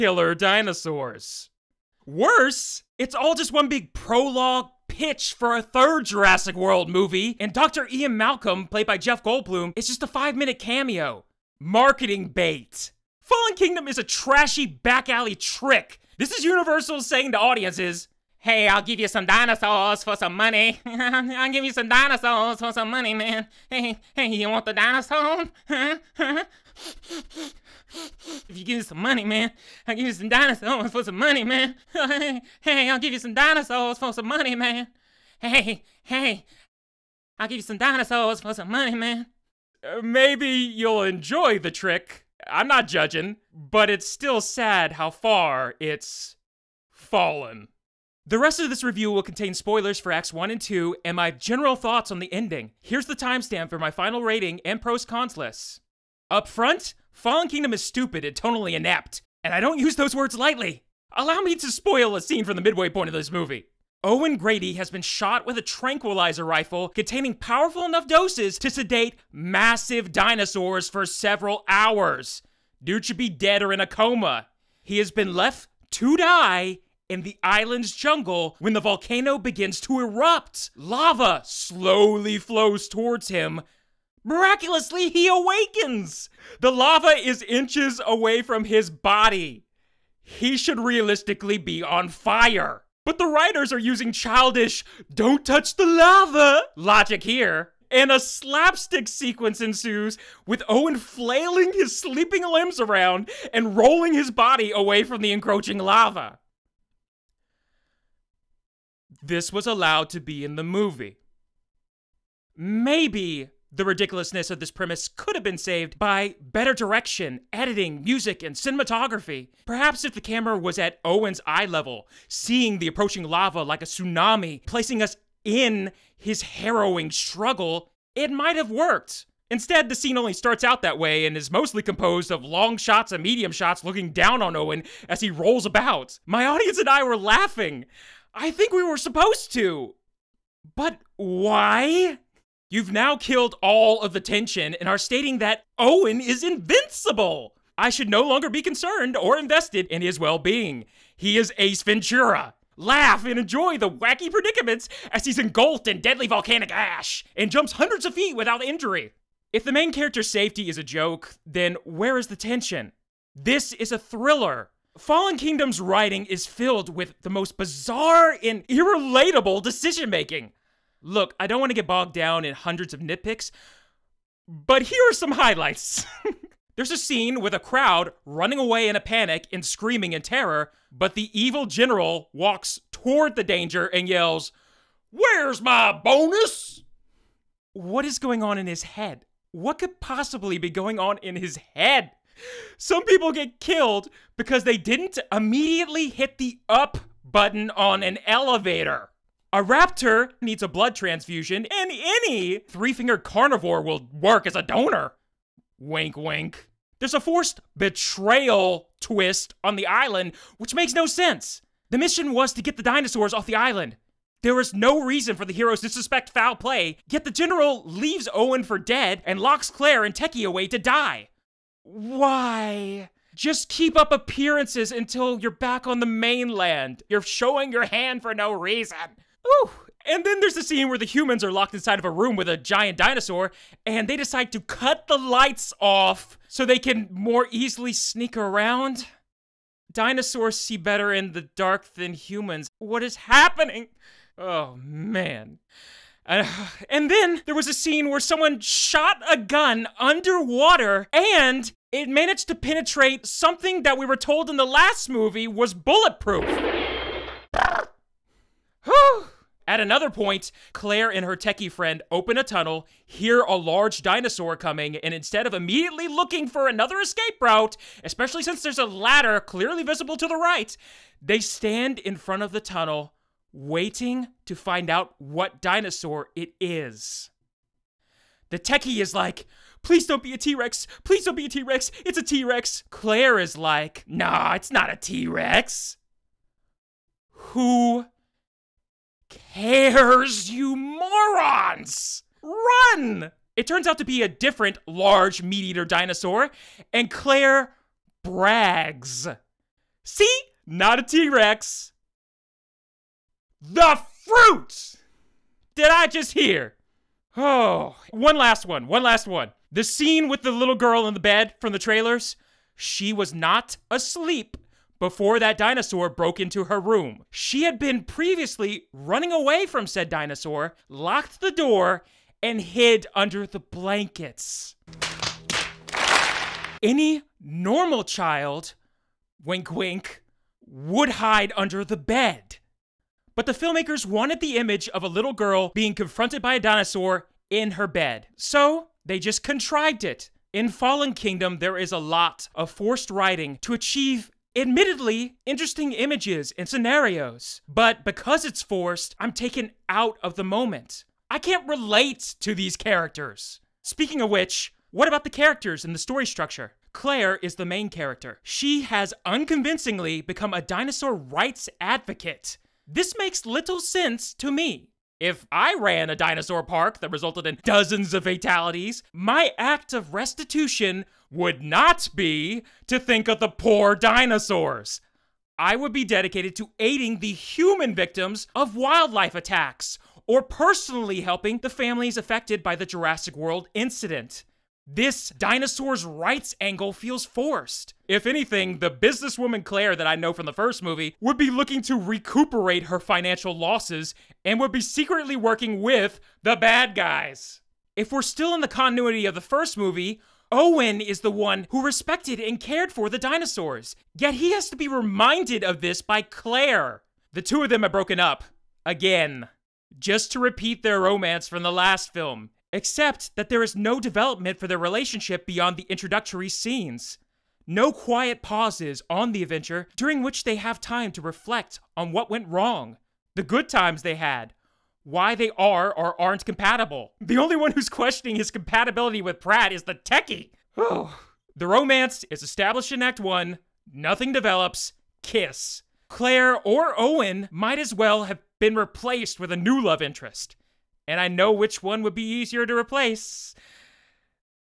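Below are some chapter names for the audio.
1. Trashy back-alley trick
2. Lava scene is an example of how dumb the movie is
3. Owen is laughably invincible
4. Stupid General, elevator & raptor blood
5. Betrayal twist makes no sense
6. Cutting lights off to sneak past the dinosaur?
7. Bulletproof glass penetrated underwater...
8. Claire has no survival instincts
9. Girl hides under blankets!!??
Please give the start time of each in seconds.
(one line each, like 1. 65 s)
1. 12 s
2. 56 s
3. 136 s
4. 176 s
5. 206 s
6. 230 s
7. 246 s
8. 259 s
9. 309 s.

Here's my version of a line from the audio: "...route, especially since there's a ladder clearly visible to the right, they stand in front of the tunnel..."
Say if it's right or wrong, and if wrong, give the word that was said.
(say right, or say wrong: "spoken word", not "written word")
right.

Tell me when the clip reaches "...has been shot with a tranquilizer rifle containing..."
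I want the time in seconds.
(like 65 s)
64 s.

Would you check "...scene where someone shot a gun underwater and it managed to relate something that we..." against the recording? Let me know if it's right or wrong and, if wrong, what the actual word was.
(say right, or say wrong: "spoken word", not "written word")
wrong: "penetrate", not "relate".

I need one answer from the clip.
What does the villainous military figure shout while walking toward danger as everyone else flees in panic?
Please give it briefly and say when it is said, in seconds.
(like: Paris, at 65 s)
Where's my bonus?, at 185 s.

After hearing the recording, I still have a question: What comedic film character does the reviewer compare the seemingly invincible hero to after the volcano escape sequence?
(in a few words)
Ace Ventura.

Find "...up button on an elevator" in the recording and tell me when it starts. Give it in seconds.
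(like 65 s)
196 s.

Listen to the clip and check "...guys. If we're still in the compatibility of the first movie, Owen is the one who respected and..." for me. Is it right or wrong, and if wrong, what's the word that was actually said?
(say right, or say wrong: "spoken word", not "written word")
wrong: "continuity", not "compatibility".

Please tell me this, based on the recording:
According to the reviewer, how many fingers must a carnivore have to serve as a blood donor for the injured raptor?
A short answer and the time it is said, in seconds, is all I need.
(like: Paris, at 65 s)
3, at 202 s.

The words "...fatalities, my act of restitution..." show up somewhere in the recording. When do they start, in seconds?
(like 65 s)
368 s.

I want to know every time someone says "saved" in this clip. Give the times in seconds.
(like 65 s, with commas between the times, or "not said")
115 s.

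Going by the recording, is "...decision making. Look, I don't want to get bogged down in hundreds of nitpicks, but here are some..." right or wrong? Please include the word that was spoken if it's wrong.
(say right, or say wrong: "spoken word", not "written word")
right.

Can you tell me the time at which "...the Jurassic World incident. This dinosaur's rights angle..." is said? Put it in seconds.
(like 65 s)
382 s.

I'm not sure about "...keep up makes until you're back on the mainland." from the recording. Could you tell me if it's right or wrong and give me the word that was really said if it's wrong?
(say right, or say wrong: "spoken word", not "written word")
wrong: "appearances", not "makes".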